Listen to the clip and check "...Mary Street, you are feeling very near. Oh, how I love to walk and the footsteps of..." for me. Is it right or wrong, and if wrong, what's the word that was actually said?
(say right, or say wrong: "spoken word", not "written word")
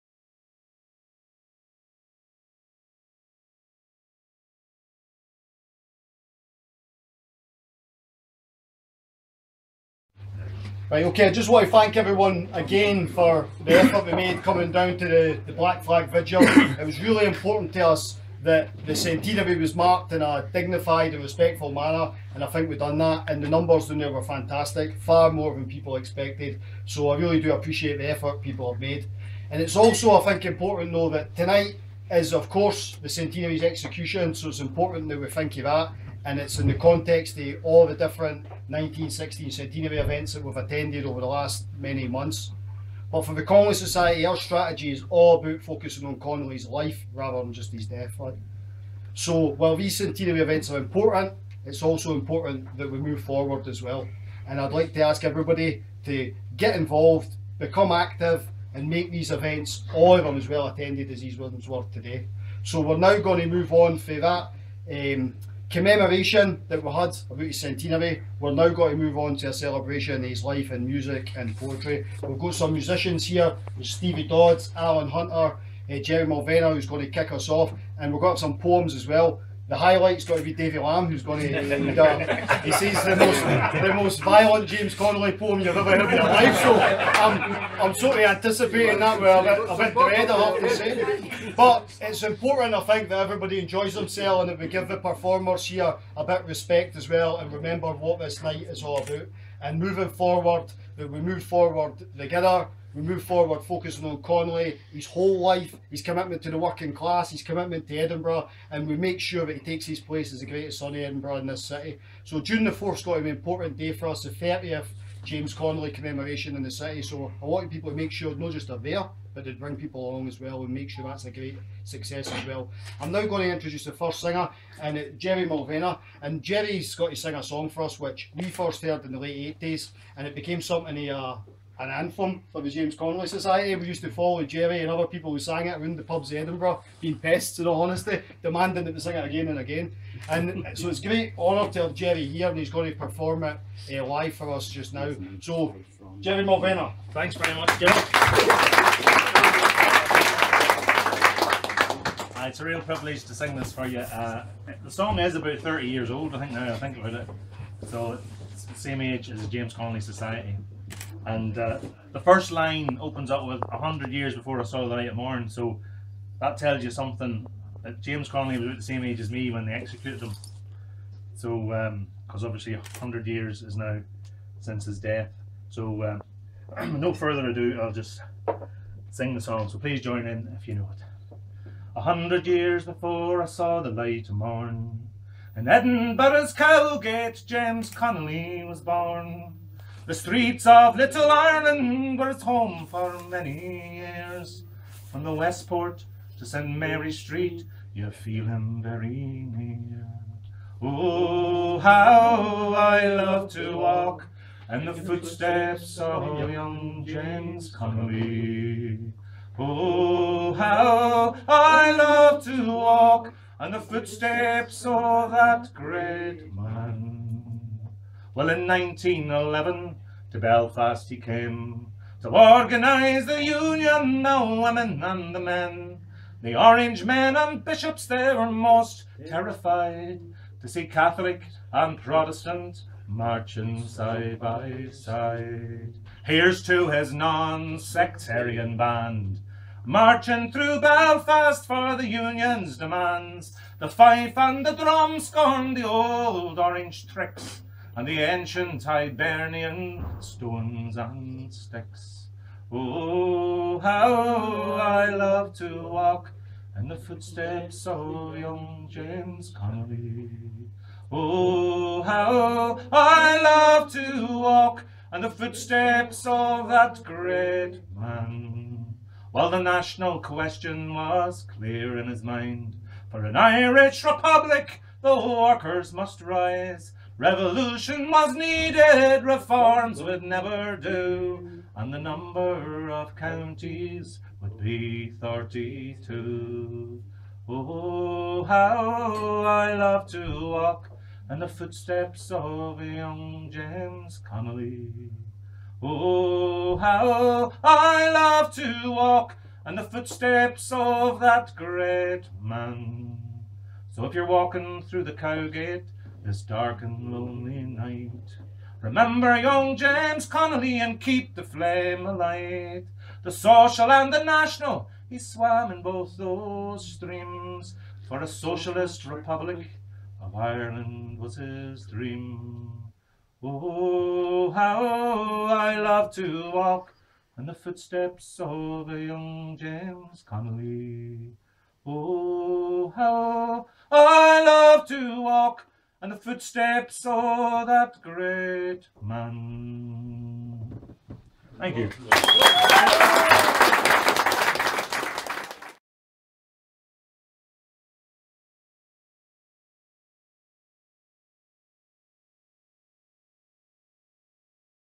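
right.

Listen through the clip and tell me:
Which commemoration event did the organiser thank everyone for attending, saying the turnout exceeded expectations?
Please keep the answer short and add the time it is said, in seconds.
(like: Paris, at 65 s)
Black Flag Vigil, at 15 s.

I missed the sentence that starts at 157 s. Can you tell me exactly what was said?
So it's the same age as the James Connolly Society.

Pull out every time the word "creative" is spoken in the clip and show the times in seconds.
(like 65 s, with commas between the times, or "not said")
not said.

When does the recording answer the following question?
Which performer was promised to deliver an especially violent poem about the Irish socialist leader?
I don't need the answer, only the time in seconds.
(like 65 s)
80 s.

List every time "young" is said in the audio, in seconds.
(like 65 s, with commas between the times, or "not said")
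206 s, 258 s, 292 s, 309 s, 328 s.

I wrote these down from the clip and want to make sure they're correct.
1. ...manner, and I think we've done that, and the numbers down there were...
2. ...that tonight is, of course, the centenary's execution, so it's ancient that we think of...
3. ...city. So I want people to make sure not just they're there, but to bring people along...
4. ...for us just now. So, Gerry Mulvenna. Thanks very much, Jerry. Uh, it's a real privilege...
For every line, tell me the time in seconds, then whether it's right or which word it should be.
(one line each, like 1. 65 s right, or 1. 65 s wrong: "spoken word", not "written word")
1. 21 s right
2. 31 s wrong: "important", not "ancient"
3. 116 s right
4. 144 s right.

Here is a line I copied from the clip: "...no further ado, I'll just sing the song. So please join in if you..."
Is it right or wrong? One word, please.
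right.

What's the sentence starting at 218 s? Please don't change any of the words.
Well, in 1911 to Belfast he came to organise the union, the women and the men.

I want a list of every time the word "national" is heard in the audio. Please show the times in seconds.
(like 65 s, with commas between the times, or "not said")
269 s, 314 s.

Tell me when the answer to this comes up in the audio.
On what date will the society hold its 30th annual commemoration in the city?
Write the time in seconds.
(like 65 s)
112 s.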